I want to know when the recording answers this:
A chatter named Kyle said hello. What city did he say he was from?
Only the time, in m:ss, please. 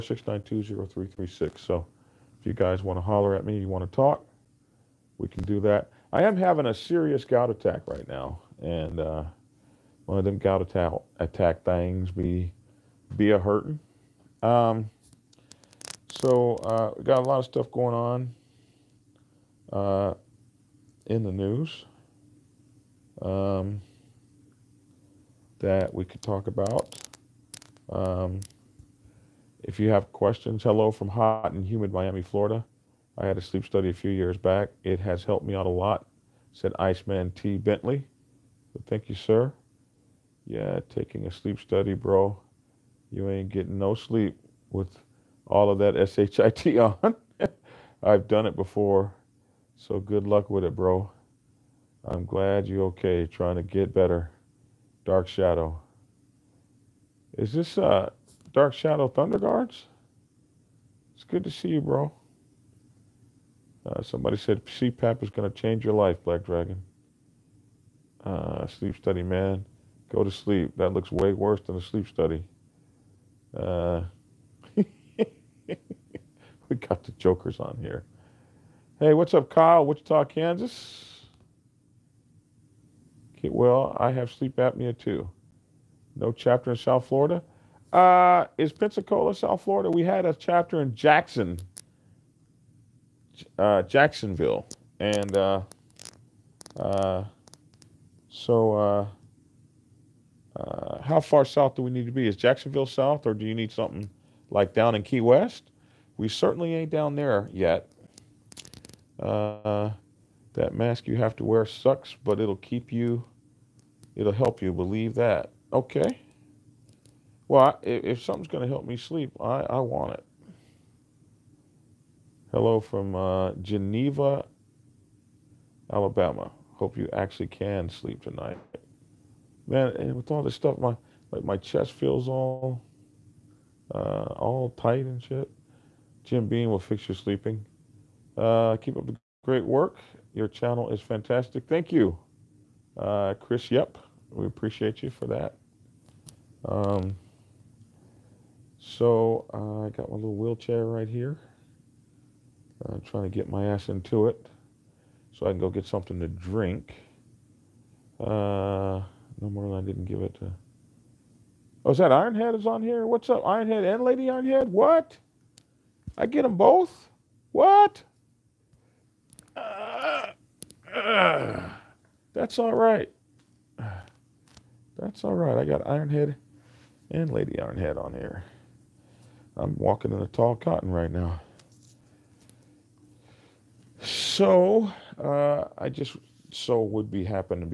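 1:19.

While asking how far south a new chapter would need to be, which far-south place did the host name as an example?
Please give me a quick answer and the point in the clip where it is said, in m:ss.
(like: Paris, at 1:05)
Key West, at 1:45.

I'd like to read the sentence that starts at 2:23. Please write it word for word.
Yep, we appreciate you for that.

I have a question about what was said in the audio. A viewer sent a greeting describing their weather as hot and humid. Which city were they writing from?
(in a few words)
Miami.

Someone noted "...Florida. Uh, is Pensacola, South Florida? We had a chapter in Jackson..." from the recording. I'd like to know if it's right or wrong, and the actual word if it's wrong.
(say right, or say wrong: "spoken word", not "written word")
right.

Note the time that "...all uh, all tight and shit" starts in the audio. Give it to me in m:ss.
2:12.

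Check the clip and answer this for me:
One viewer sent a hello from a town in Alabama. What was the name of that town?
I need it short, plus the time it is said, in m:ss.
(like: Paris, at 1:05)
Geneva, at 2:03.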